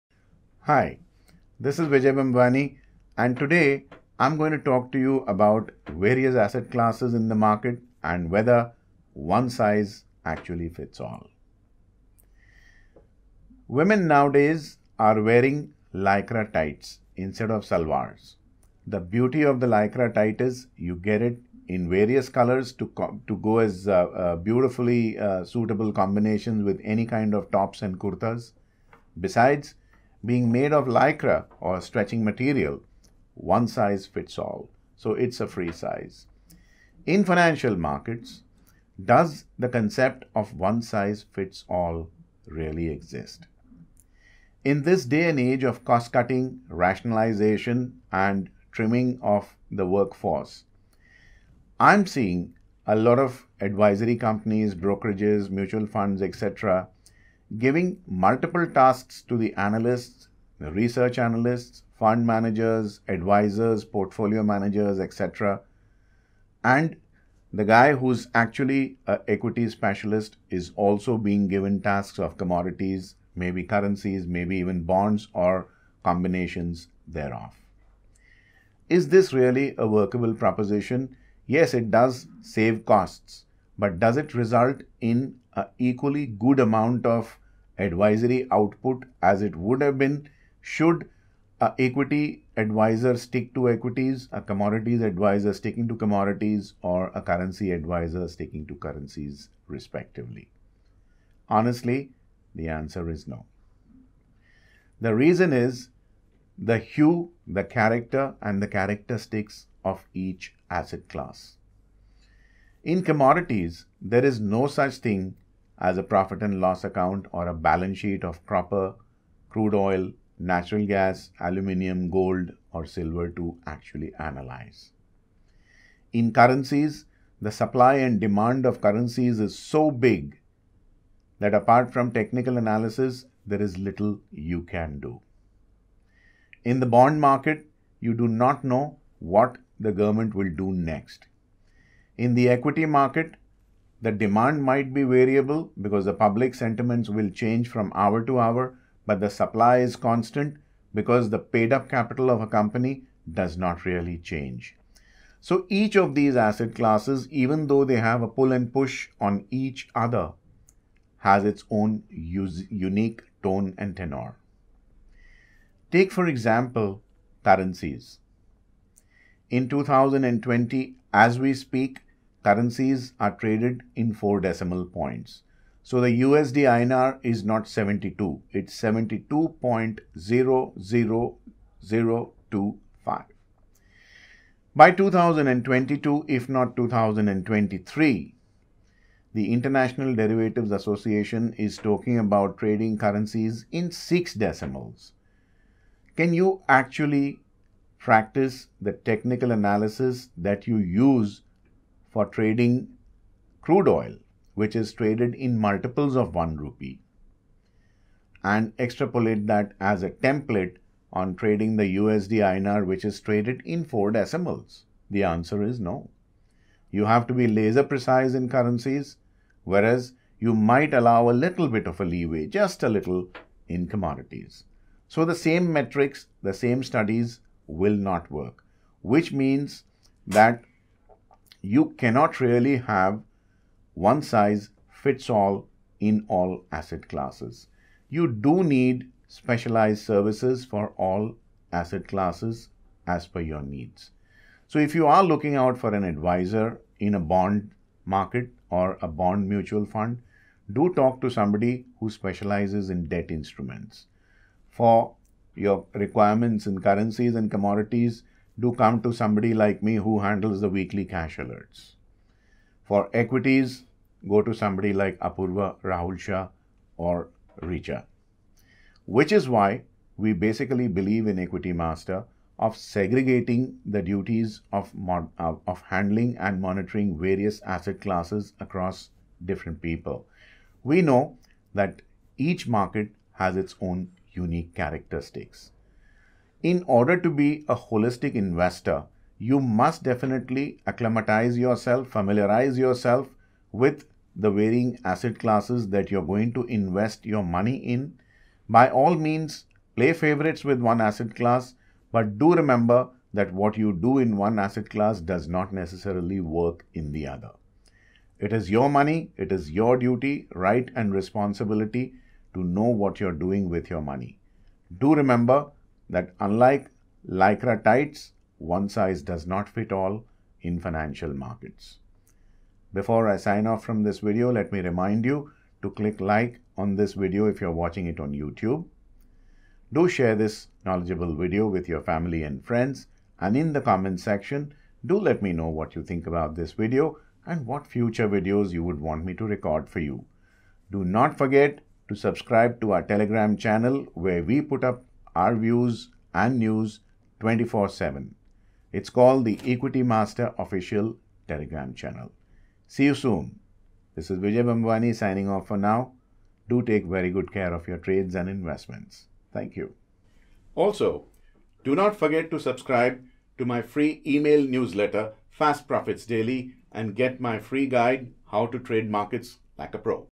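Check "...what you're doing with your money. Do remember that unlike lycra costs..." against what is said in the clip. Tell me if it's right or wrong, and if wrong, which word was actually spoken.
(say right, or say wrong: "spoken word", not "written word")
wrong: "tights", not "costs".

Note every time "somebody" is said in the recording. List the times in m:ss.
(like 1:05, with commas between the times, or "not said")
4:11, 4:19, 4:24.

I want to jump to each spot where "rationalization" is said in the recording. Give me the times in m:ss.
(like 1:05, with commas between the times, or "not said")
0:46.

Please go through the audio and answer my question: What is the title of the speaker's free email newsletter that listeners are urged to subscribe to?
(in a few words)
Fast Profits Daily.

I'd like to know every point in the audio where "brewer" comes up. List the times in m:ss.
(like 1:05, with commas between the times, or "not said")
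not said.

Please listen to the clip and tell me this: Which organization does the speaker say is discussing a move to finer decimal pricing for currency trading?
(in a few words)
International Derivatives Association.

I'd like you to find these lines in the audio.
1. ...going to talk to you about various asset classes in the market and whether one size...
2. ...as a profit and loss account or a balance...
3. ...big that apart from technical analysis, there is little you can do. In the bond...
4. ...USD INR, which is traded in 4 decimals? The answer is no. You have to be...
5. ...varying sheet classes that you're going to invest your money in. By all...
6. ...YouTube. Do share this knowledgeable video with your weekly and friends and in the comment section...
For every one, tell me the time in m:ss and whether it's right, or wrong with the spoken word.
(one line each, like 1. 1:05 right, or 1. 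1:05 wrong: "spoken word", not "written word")
1. 0:04 right
2. 1:55 right
3. 2:09 right
4. 3:31 right
5. 4:54 wrong: "asset", not "sheet"
6. 5:28 wrong: "family", not "weekly".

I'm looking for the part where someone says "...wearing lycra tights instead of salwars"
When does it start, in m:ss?
0:15.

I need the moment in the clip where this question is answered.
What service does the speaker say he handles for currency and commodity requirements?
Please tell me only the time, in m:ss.
4:20.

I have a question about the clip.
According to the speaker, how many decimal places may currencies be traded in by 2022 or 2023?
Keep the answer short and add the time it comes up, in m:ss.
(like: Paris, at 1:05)
6, at 3:13.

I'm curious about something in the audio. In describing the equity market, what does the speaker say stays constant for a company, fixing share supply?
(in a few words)
Paid up capital.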